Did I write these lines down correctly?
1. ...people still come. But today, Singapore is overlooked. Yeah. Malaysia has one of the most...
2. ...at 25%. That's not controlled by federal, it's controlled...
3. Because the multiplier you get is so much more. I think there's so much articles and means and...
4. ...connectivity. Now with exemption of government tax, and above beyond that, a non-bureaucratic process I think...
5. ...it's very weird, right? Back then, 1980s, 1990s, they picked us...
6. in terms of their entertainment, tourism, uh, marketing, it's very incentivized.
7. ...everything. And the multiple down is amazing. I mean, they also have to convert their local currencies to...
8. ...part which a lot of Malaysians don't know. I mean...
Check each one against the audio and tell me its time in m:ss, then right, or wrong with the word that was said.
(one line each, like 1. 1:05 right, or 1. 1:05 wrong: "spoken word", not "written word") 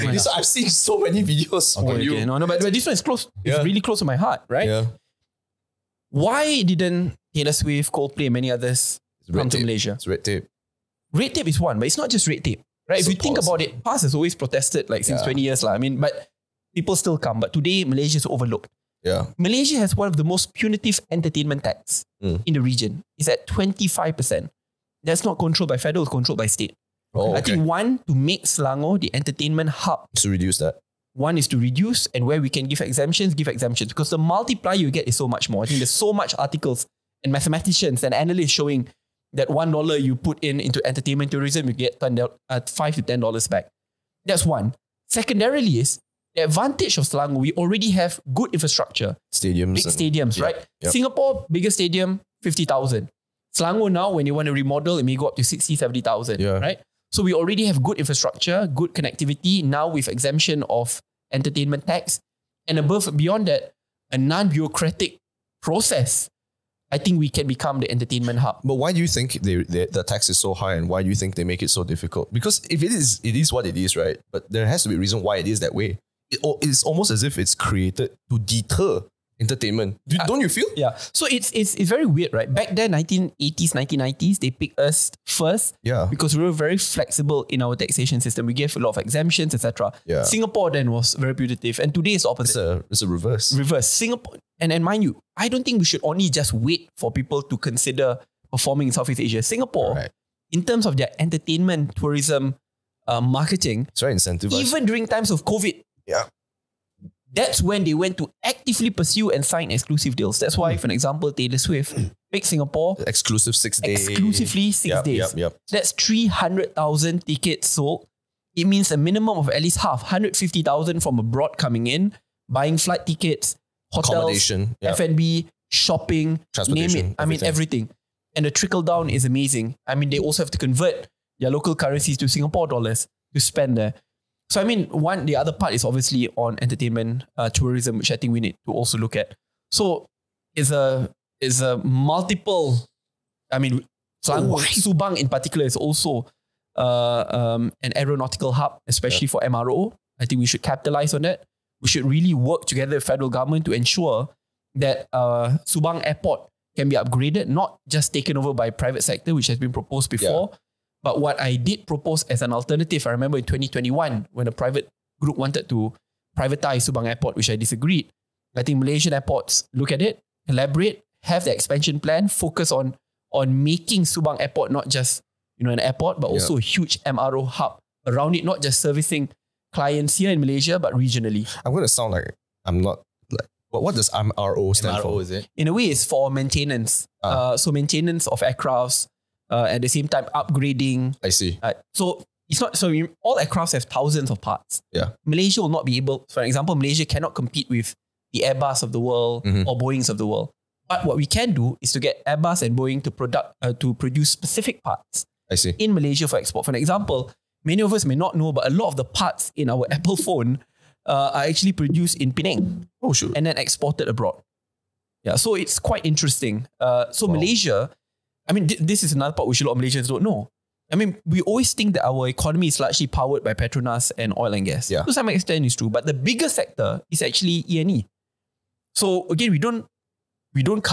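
1. 0:16 wrong: "Malaysia", not "Singapore"
2. 0:23 right
3. 0:33 wrong: "mathematicians", not "means"
4. 0:58 wrong: "entertainment", not "government"
5. 1:21 right
6. 1:40 right
7. 2:07 wrong: "trickle", not "multiple"
8. 3:39 right.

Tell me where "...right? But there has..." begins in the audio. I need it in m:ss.
1:13.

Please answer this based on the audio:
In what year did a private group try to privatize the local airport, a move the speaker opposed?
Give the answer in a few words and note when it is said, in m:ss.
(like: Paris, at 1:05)
2021, at 2:43.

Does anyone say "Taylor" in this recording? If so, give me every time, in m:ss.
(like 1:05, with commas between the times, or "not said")
0:07, 1:51.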